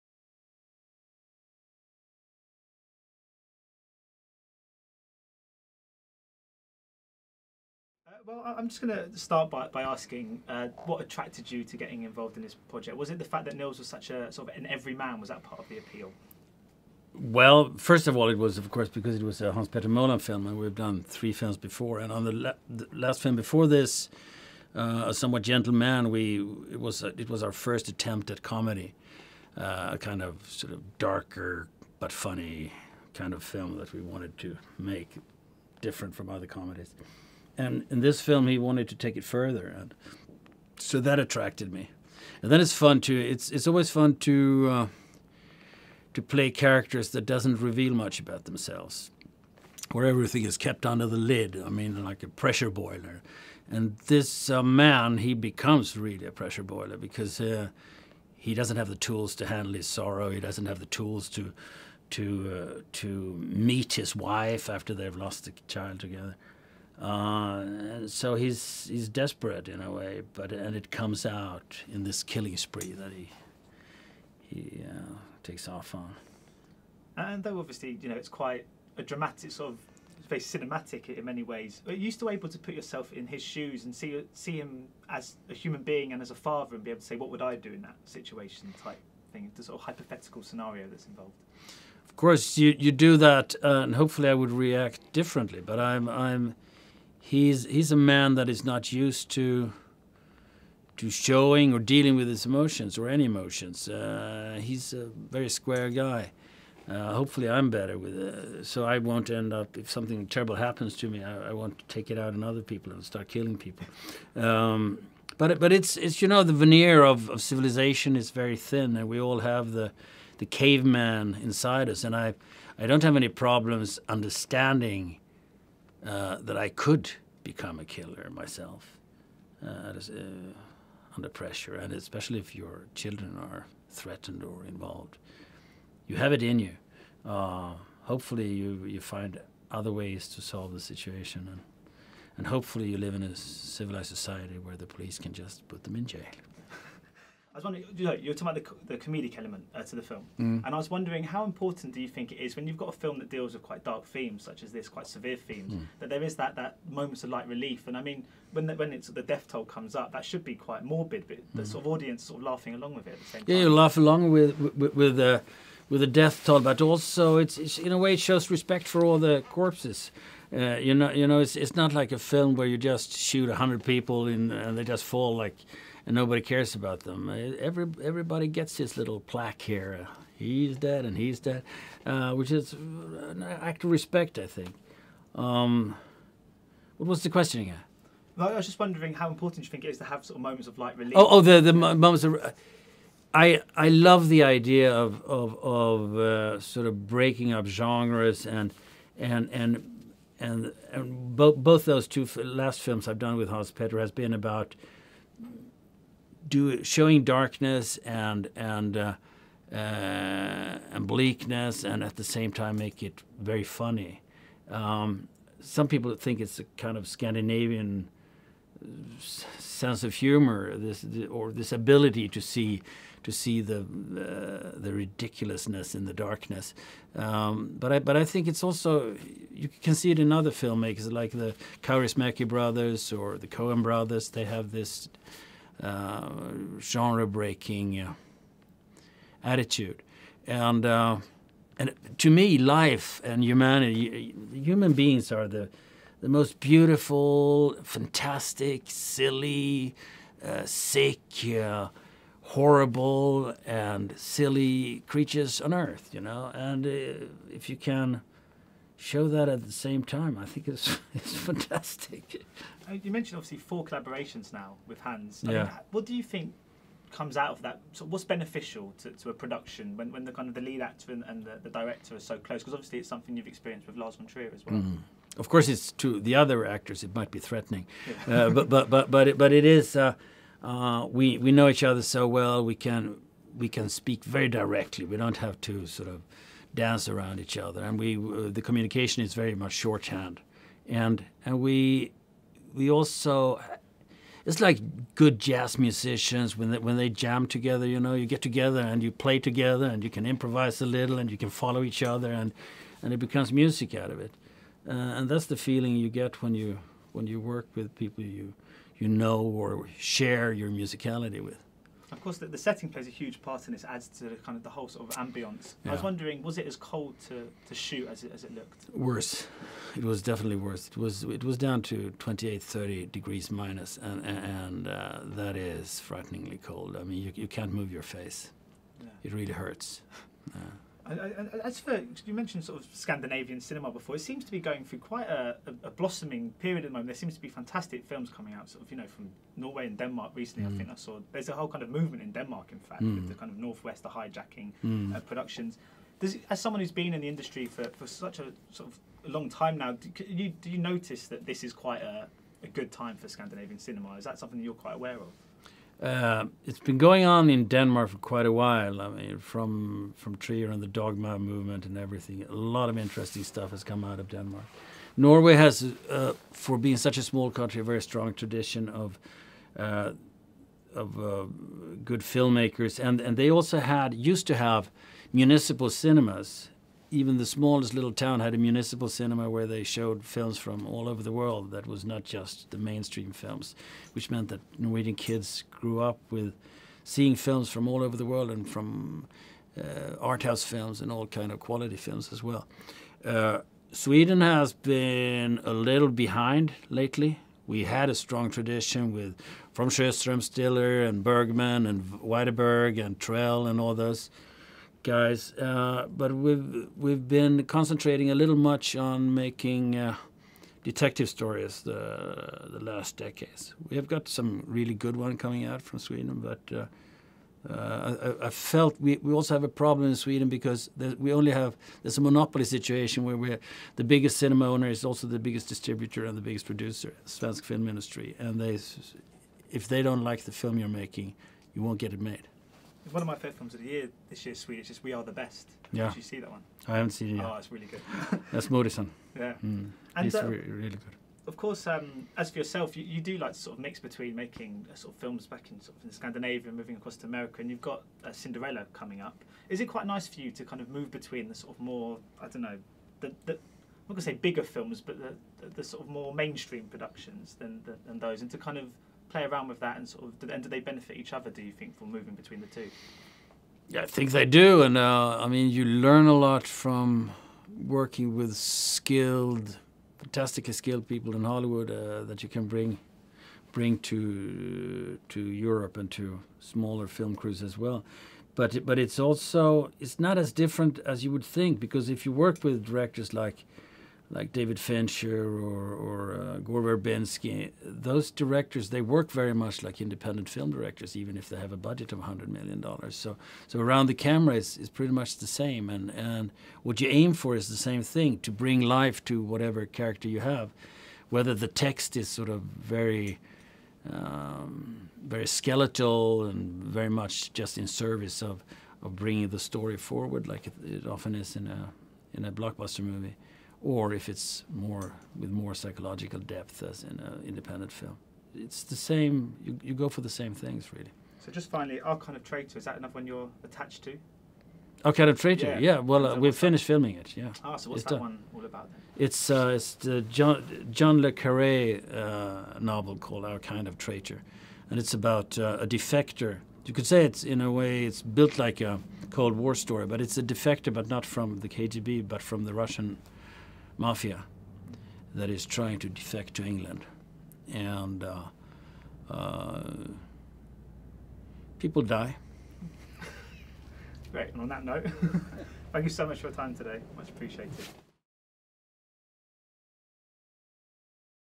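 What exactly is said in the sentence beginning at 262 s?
Uh, you mentioned obviously four collaborations now with Hans.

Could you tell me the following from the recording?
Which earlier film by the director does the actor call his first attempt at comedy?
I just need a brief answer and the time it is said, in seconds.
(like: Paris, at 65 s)
A Somewhat Gentle Man, at 25 s.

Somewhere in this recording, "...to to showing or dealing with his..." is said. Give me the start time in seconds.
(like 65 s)
99 s.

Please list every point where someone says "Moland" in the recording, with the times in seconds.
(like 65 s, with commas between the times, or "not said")
19 s.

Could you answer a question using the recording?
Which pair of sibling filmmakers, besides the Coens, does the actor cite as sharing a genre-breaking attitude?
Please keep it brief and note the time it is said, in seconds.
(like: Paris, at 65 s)
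Kaurismäki brothers, at 231 s.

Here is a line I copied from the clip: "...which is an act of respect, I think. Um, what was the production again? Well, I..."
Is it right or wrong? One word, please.
wrong.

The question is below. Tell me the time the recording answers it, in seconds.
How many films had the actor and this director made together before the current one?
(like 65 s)
21 s.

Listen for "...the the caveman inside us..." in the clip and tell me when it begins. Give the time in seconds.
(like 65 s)
119 s.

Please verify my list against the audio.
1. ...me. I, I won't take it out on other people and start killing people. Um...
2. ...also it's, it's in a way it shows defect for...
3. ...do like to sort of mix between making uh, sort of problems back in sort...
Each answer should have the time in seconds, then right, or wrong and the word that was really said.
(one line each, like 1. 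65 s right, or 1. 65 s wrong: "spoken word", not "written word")
1. 111 s right
2. 166 s wrong: "respect", not "defect"
3. 443 s wrong: "films", not "problems".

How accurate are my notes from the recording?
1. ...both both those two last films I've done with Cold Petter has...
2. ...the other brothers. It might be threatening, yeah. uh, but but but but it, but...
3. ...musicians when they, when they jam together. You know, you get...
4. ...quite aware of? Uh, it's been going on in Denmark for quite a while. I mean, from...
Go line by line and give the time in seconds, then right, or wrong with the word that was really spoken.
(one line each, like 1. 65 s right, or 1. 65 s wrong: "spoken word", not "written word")
1. 201 s wrong: "Hans", not "Cold"
2. 276 s wrong: "actors", not "brothers"
3. 295 s right
4. 354 s right.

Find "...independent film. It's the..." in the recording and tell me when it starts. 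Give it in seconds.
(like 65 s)
517 s.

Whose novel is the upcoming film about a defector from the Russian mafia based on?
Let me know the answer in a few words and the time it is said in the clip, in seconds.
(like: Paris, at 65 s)
John le Carré, at 530 s.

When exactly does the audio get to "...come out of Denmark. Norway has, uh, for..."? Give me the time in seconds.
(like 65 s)
363 s.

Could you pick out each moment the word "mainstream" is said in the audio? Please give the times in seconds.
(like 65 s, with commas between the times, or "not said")
382 s, 456 s.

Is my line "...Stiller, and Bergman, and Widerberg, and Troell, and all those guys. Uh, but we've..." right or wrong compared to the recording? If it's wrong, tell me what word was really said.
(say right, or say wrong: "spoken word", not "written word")
right.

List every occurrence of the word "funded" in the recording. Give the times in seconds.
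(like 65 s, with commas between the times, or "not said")
not said.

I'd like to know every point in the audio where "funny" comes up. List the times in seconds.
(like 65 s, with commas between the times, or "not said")
32 s, 213 s.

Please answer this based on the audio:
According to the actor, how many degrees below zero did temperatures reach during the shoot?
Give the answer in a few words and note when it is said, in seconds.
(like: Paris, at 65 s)
28 to 30, at 322 s.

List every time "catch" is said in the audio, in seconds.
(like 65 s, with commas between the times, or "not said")
not said.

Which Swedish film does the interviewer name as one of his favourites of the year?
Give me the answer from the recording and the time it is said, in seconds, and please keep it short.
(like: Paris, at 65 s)
We Are the Best, at 435 s.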